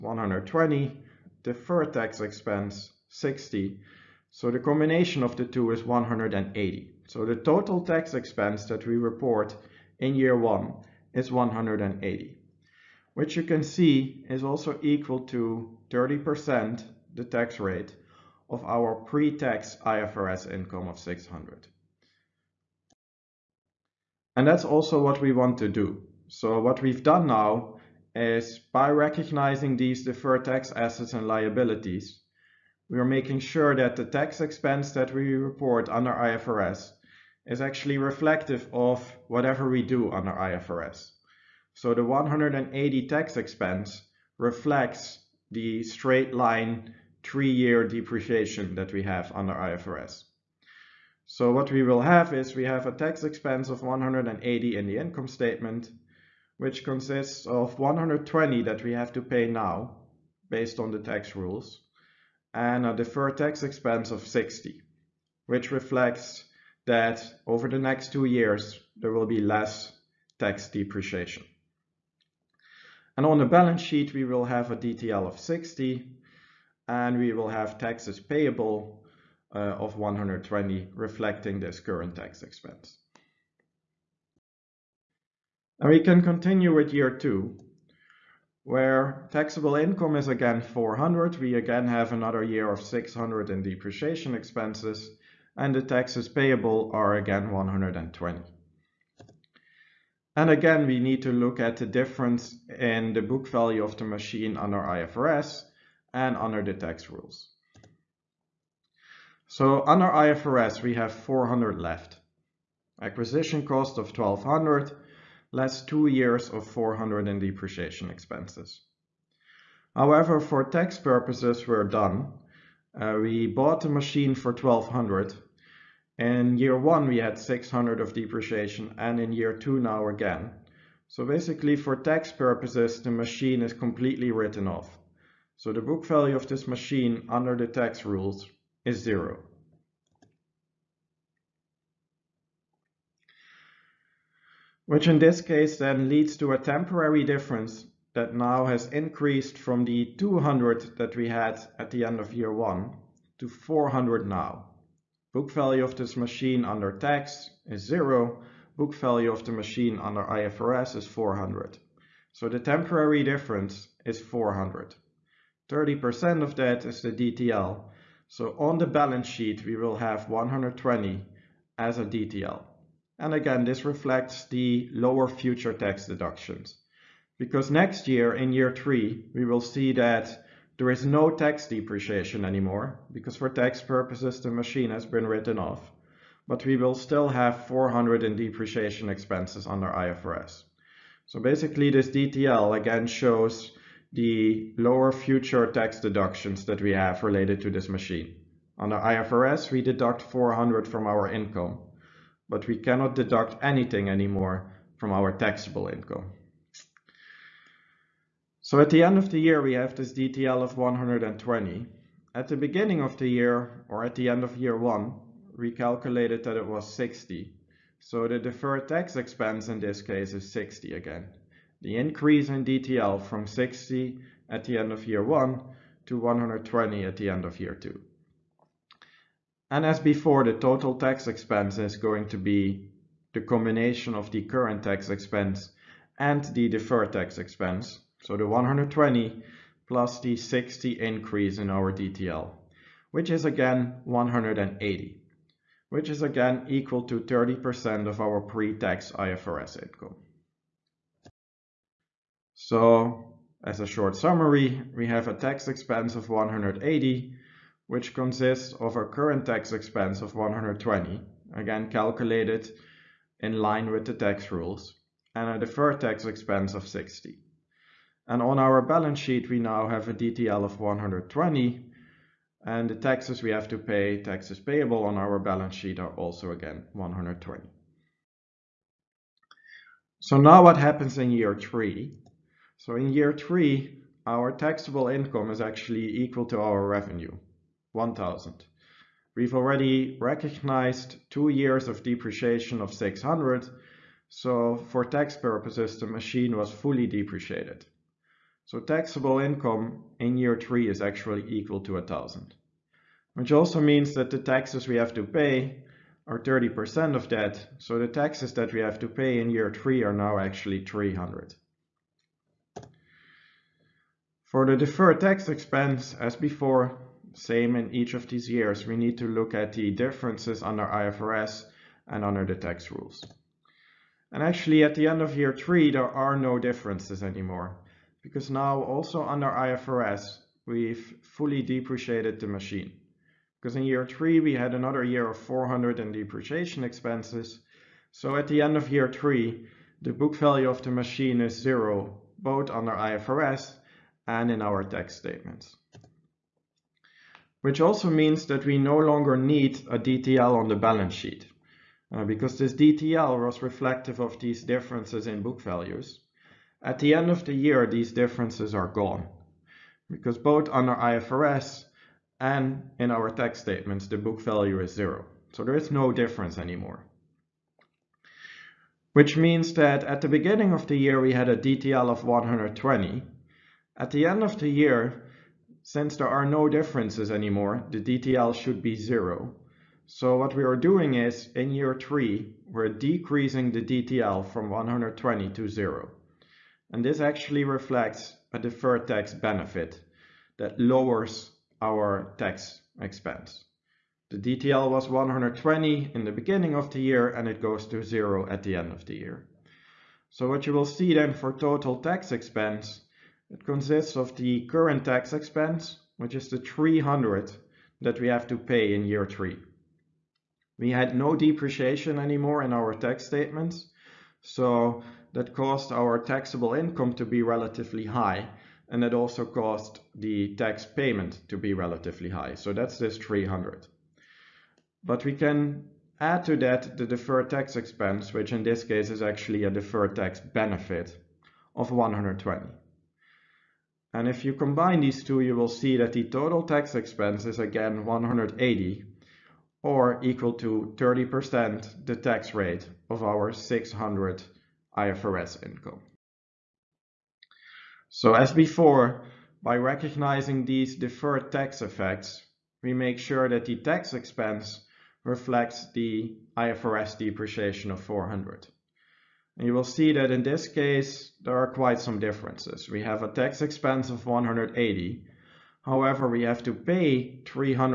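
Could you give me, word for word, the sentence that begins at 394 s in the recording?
The DTL was 120 in the beginning of the year and it goes to zero at the end of the year.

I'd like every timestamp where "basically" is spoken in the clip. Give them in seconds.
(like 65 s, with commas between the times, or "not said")
131 s, 191 s.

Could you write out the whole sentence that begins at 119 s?
However, for tax purposes, we're done.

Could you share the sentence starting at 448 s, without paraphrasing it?
So as before, by recognizing these deferred tax effects, we make sure that the tax expense reflects the IFRS depreciation of 400.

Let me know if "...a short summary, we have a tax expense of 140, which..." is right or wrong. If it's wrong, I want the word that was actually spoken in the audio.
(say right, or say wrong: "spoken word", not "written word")
wrong: "180", not "140".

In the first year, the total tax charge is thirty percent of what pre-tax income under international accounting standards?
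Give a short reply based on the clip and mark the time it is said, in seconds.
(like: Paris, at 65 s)
600, at 19 s.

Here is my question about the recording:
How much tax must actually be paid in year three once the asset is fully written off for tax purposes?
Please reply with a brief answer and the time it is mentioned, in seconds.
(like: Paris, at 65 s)
300, at 310 s.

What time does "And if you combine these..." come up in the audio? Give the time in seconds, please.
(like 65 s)
434 s.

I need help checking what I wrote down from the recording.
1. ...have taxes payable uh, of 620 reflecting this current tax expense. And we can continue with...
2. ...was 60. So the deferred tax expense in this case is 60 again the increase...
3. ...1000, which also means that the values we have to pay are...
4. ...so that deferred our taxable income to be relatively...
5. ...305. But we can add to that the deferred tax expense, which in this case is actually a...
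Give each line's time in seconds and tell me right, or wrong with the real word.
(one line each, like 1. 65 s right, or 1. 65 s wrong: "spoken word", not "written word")
1. 77 s wrong: "120", not "620"
2. 216 s right
3. 301 s wrong: "taxes", not "values"
4. 414 s wrong: "caused", not "deferred"
5. 423 s wrong: "300", not "305".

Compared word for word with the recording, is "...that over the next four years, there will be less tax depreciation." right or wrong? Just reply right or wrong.
wrong.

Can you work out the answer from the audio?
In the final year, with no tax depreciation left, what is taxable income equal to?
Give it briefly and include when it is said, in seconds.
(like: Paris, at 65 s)
1000, at 286 s.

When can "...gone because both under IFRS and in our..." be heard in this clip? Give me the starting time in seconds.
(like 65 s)
358 s.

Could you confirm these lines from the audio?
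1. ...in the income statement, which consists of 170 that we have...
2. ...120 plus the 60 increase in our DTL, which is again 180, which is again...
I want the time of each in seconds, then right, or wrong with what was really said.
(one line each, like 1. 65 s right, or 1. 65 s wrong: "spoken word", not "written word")
1. 54 s wrong: "120", not "170"
2. 238 s right.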